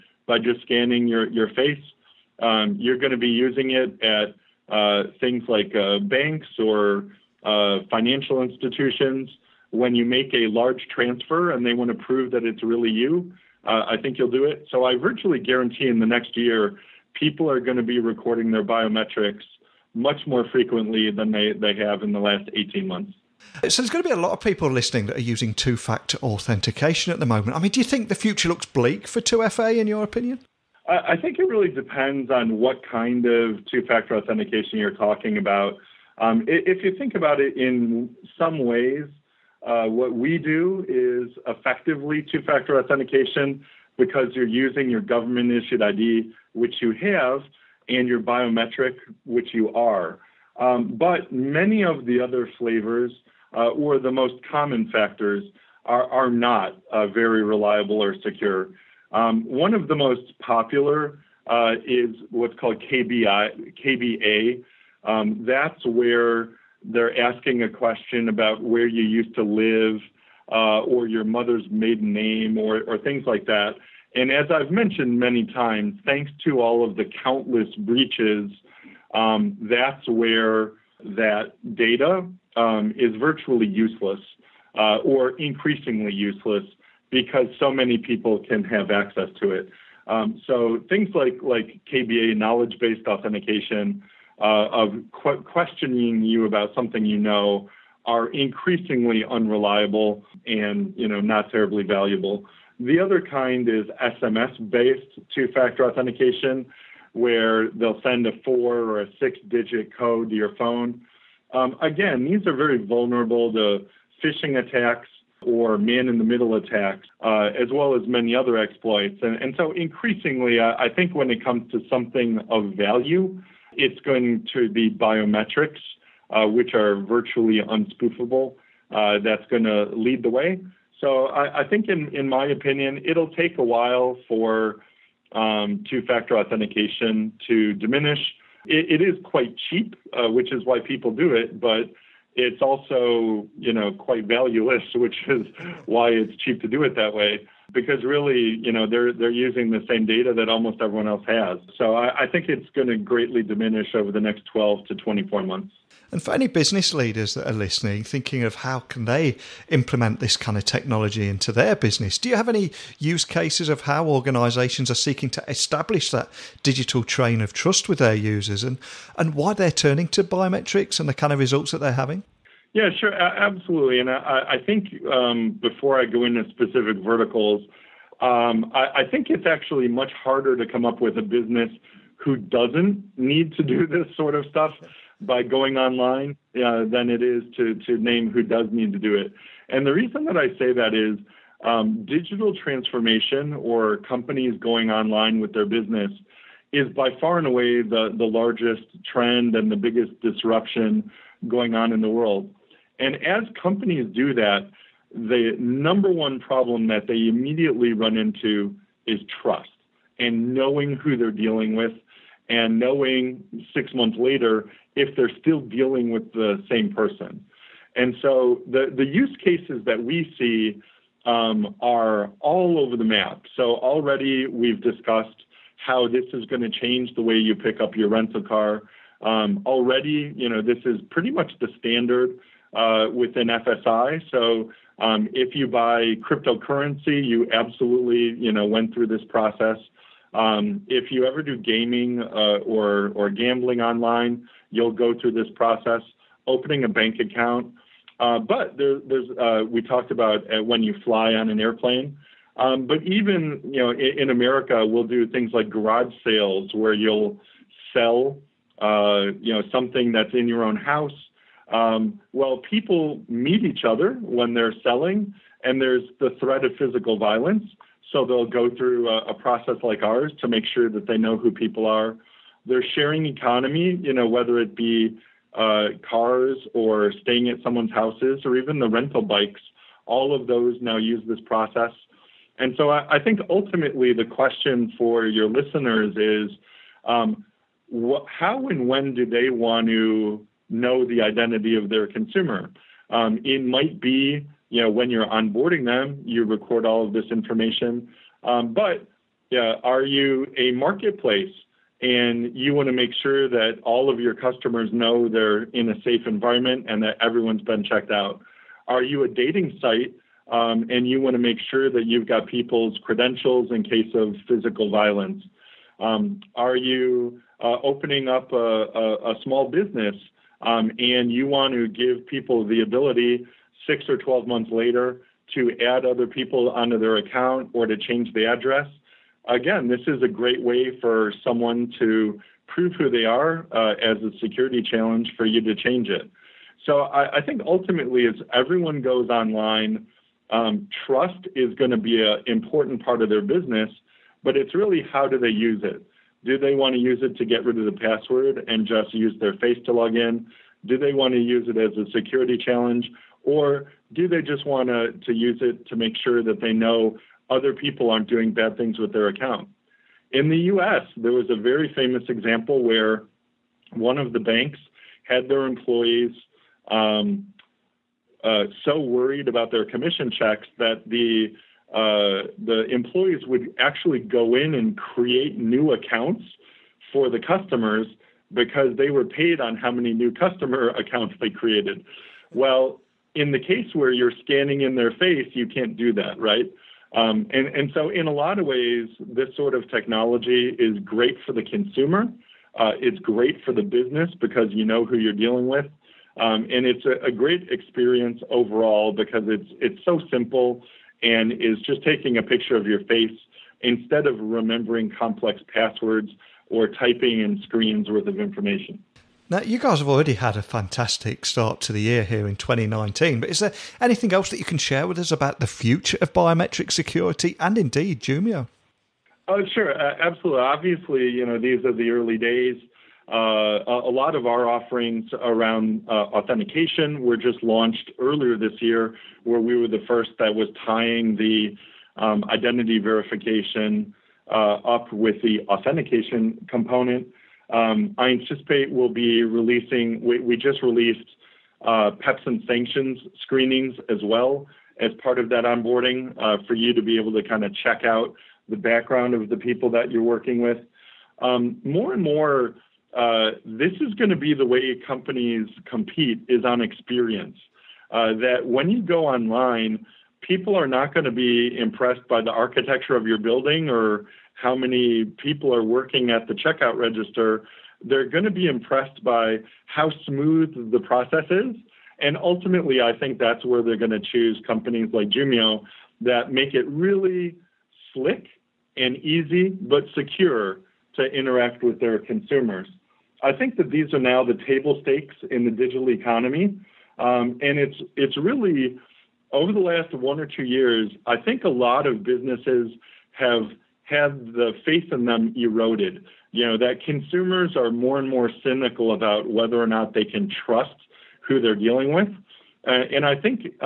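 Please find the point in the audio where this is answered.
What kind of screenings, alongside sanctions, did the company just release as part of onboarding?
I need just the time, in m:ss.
7:22.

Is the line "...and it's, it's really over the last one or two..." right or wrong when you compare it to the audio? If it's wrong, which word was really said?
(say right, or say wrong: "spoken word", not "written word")
right.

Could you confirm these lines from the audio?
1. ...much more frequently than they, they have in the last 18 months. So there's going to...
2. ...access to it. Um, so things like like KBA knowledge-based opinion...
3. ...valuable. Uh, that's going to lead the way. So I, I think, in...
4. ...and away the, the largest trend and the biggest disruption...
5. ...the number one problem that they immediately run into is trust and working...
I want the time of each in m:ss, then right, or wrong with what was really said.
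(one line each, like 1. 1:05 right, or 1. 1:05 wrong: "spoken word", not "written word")
1. 0:19 right
2. 1:28 wrong: "authentication", not "opinion"
3. 2:07 wrong: "unspoofable", not "valuable"
4. 3:17 right
5. 3:25 wrong: "knowing", not "working".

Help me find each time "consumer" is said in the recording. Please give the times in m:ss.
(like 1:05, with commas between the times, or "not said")
4:52, 6:31, 8:02, 8:17.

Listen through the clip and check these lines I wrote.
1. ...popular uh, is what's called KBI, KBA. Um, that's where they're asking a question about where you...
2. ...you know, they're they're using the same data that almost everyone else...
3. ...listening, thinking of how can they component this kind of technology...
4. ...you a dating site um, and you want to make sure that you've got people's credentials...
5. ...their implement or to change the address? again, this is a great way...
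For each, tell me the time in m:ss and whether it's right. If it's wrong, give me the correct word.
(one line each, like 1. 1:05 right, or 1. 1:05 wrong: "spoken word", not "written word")
1. 1:00 right
2. 2:28 right
3. 2:37 wrong: "implement", not "component"
4. 5:09 right
5. 5:26 wrong: "account", not "implement".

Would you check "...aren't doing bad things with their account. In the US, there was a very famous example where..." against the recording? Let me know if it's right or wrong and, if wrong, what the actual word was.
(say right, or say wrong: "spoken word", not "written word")
right.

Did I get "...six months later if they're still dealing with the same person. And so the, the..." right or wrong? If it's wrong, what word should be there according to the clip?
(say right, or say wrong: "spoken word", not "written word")
right.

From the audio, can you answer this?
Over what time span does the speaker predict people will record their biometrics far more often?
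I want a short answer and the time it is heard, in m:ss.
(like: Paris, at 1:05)
next year, at 0:16.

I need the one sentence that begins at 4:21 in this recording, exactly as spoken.
Um, well, people meet each other when they're selling, and there's the threat of physical violence.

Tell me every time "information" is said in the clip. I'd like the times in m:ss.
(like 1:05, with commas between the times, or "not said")
4:57, 6:48.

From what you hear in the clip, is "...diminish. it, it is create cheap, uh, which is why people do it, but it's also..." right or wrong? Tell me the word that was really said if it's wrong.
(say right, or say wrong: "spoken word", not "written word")
wrong: "quite", not "create".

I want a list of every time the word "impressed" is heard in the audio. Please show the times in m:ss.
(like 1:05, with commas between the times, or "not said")
7:41, 7:48.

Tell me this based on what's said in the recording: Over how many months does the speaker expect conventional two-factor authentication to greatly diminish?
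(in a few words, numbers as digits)
12 to 24 months.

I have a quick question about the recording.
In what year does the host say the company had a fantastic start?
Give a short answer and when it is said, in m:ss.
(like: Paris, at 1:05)
2019, at 6:52.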